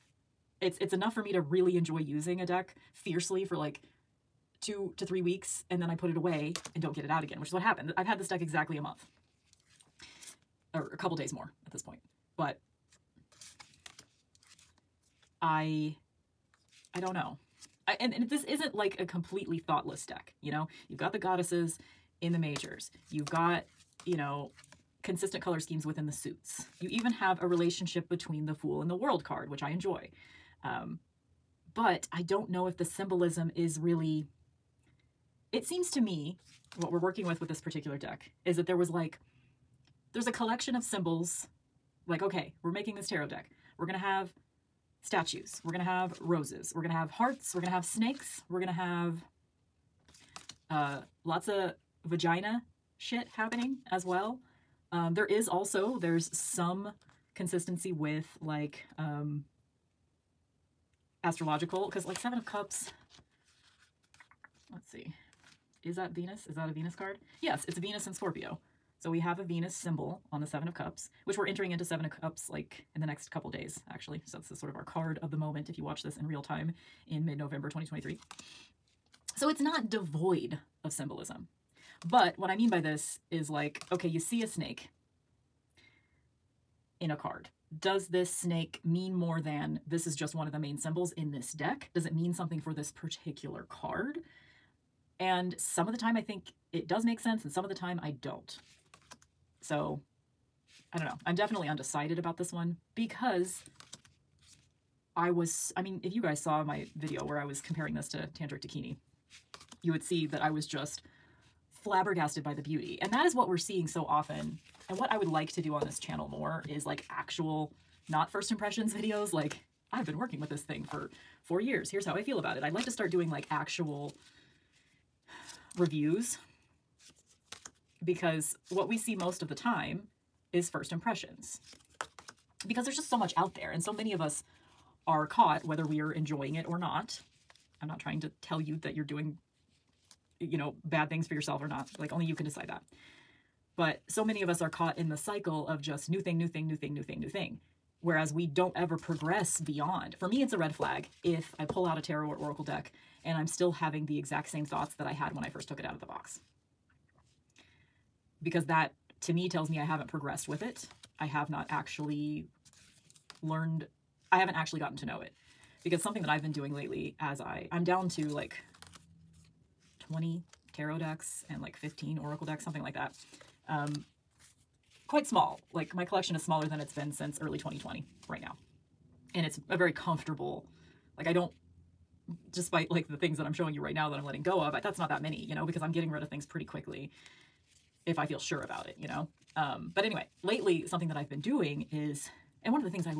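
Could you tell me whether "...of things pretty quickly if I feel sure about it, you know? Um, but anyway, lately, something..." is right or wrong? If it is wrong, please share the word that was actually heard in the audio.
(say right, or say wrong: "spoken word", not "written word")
right.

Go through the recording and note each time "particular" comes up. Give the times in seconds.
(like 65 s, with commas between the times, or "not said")
37 s, 92 s.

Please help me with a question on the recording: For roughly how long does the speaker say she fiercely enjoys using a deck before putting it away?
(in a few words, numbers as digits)
2 to 3 weeks.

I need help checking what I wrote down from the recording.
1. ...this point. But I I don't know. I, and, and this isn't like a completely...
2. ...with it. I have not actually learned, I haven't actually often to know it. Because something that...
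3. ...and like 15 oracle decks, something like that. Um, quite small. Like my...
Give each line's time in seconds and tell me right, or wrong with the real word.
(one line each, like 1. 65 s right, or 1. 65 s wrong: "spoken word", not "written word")
1. 11 s right
2. 160 s wrong: "gotten", not "often"
3. 171 s right.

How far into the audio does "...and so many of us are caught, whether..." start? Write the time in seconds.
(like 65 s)
133 s.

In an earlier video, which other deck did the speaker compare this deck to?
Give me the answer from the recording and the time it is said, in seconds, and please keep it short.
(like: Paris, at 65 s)
Tantric Bikini, at 108 s.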